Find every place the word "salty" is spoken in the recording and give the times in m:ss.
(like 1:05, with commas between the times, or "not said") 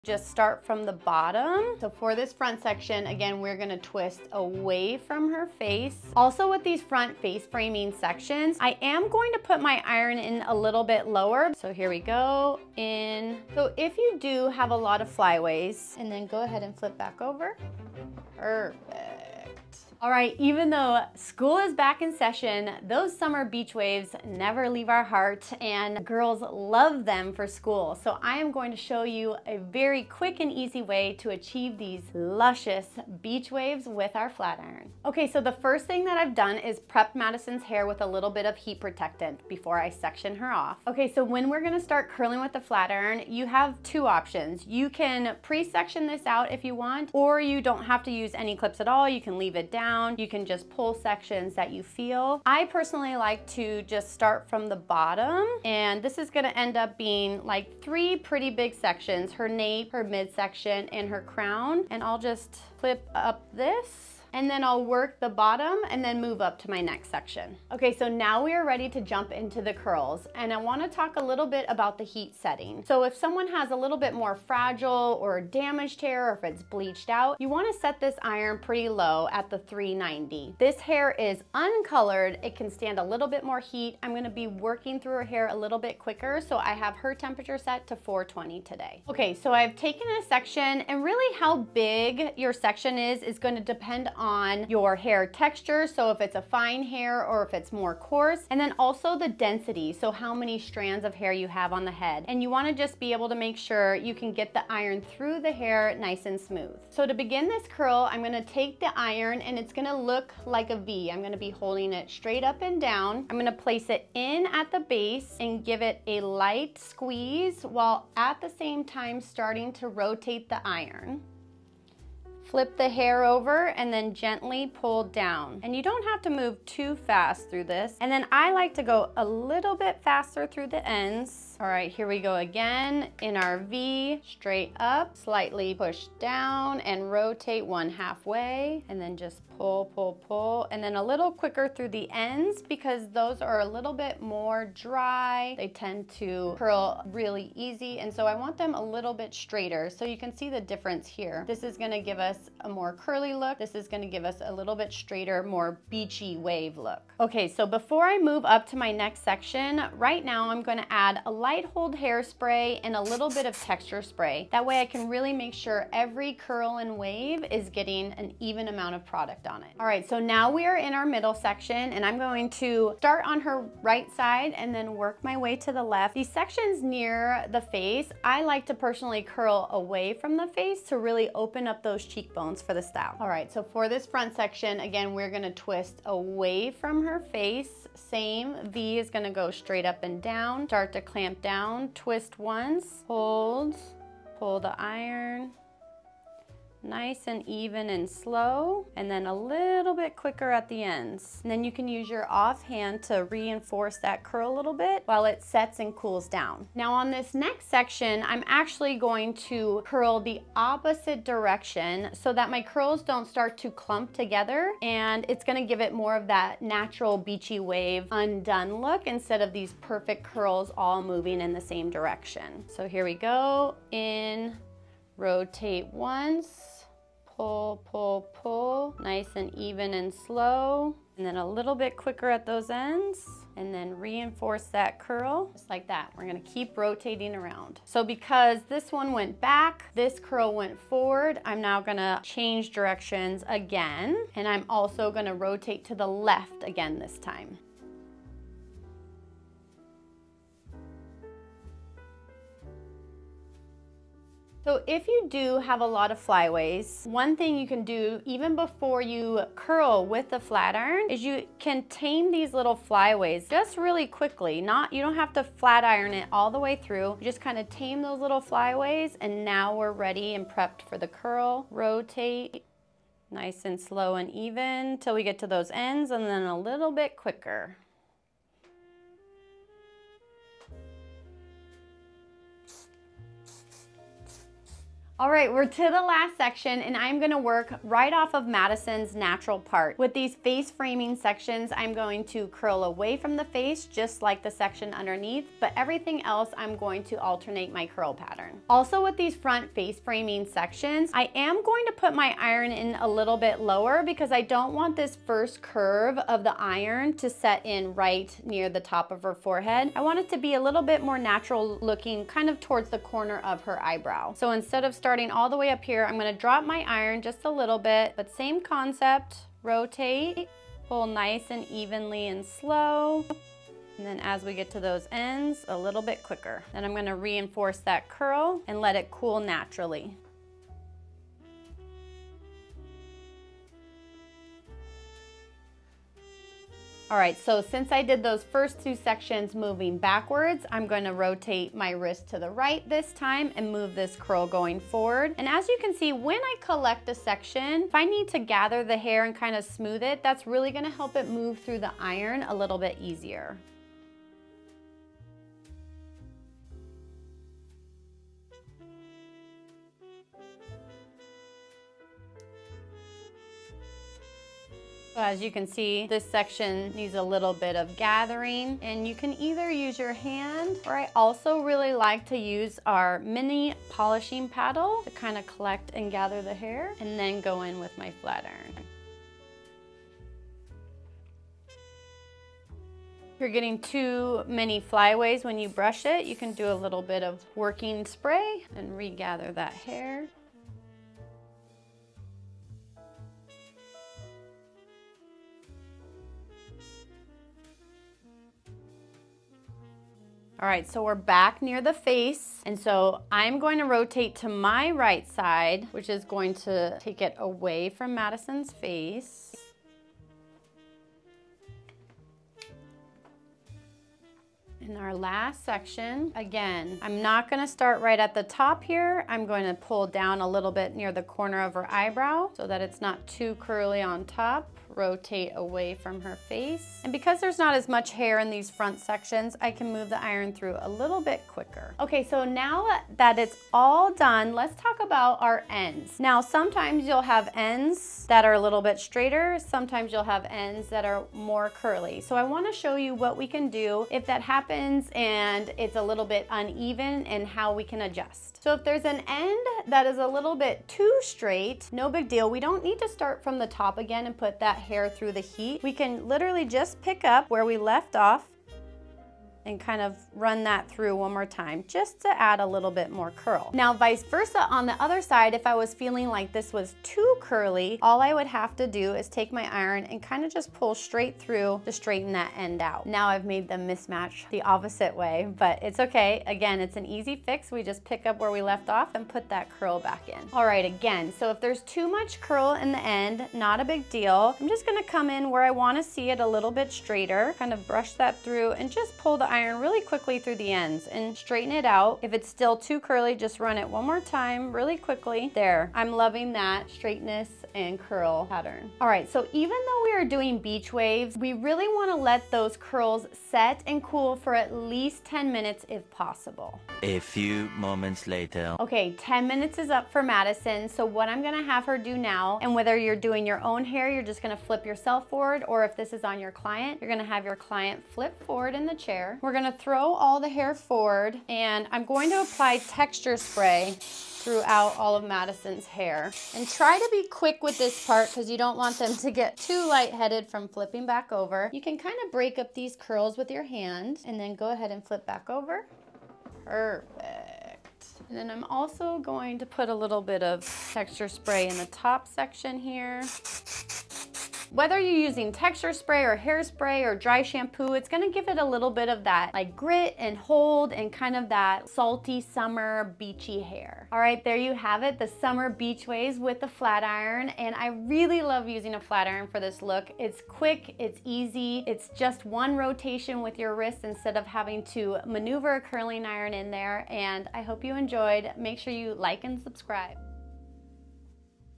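9:11.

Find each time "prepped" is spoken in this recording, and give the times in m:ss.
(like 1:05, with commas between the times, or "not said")
0:36, 4:30.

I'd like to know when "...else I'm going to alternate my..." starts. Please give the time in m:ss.
4:56.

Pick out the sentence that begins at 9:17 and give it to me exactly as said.
And I really love using a flat iron for this look.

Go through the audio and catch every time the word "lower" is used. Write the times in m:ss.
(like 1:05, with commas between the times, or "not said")
0:11, 5:03.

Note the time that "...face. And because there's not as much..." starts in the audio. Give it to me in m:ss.
7:06.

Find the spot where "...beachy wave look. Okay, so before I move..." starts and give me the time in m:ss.
2:35.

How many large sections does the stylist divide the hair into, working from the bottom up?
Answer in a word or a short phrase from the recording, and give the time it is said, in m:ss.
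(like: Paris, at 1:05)
3, at 0:57.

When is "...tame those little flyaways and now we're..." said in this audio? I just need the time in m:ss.
4:27.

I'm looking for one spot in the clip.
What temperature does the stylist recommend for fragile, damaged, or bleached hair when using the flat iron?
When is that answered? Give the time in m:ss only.
1:19.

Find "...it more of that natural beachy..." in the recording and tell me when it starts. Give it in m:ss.
3:35.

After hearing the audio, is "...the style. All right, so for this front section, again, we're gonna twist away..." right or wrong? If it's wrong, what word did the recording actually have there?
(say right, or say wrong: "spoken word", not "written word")
right.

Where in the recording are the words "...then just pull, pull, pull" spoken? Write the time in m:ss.
2:18.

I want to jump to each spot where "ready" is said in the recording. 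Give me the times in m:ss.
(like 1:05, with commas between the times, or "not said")
1:08, 4:29.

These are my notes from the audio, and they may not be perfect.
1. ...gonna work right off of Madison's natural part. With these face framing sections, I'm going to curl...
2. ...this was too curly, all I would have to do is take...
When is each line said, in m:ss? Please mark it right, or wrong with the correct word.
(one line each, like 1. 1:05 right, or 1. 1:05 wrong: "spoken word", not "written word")
1. 4:47 right
2. 7:46 right.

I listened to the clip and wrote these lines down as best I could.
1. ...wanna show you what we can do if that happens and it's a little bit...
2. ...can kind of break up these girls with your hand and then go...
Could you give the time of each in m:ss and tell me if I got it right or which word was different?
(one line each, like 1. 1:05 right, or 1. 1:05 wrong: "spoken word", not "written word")
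1. 7:22 right
2. 8:51 wrong: "curls", not "girls".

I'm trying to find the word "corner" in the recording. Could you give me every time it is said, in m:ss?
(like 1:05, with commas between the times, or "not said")
5:12, 7:01.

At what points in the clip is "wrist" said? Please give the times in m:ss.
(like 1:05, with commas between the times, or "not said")
5:41, 9:23.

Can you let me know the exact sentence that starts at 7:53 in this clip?
Now I've made them mismatch the opposite way, but it's okay.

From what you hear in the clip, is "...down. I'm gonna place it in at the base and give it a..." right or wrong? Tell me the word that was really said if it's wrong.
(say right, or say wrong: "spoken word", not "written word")
right.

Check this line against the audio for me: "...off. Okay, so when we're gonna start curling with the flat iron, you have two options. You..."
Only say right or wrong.
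right.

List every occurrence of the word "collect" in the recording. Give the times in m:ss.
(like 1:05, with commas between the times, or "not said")
5:46, 6:15.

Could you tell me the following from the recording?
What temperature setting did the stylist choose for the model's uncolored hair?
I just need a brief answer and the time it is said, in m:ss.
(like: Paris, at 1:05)
420, at 1:27.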